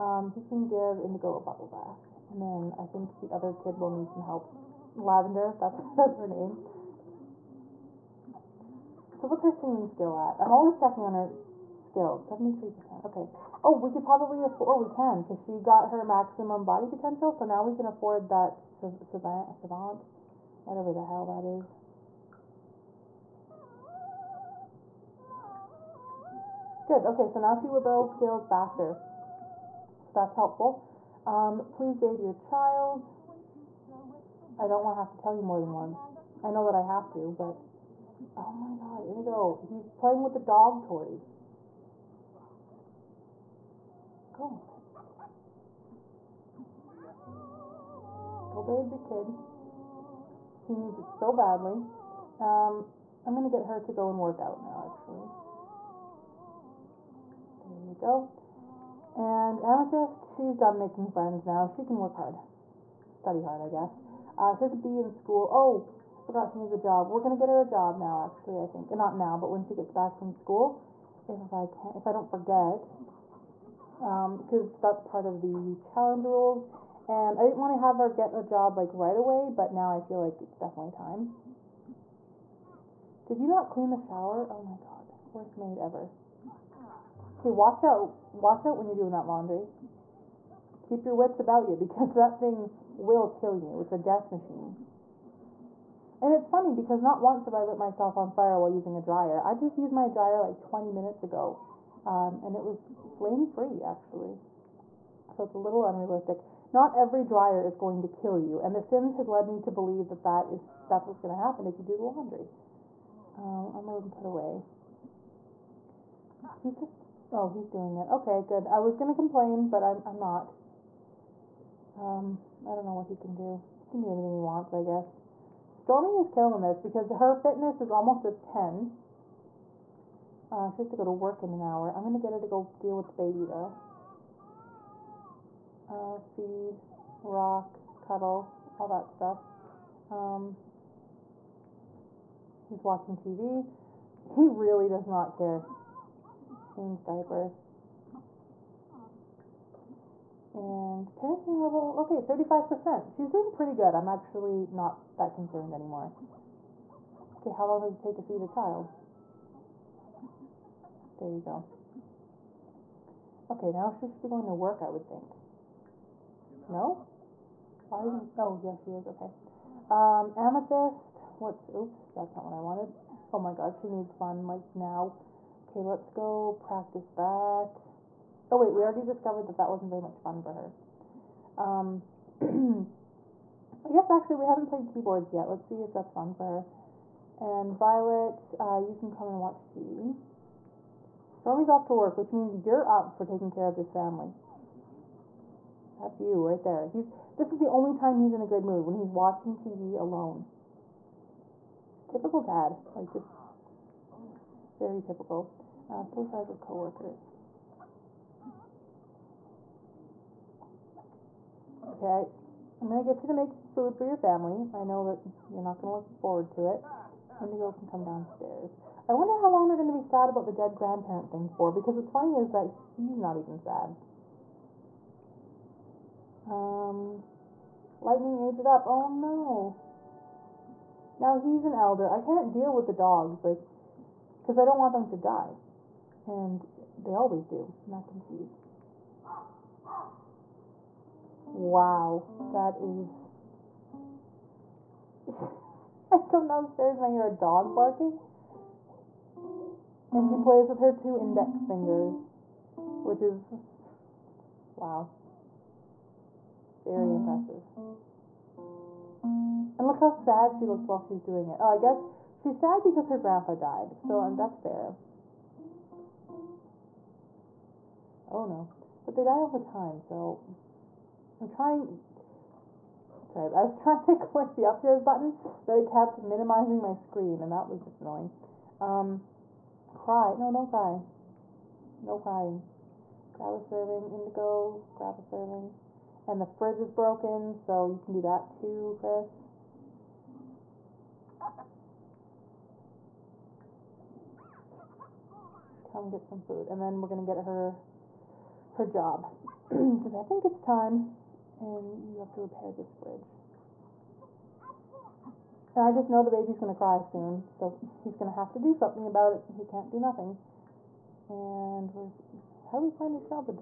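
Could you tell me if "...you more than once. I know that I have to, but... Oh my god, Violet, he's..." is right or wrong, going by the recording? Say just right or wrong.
wrong.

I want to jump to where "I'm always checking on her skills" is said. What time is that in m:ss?
0:10.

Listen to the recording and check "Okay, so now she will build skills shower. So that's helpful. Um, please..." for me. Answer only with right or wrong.
wrong.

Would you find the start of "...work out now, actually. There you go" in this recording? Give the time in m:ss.
0:54.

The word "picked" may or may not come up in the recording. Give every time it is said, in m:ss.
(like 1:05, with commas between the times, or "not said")
not said.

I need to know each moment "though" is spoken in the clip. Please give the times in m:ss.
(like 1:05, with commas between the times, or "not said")
2:13.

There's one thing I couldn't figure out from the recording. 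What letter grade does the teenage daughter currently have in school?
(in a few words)
B.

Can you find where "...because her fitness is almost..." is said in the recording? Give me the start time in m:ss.
2:06.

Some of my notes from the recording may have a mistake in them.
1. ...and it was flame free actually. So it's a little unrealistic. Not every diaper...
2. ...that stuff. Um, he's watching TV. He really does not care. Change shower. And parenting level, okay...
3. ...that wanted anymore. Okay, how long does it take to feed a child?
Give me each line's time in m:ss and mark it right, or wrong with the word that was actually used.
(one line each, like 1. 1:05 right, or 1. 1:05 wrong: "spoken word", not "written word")
1. 1:42 wrong: "dryer", not "diaper"
2. 2:18 wrong: "diaper", not "shower"
3. 2:35 wrong: "concerned", not "wanted".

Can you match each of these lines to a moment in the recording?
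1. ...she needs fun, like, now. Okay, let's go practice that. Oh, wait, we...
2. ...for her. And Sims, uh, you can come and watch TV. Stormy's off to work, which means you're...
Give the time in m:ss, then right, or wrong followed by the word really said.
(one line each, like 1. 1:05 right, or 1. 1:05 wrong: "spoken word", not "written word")
1. 2:53 right
2. 3:06 wrong: "Violet", not "Sims".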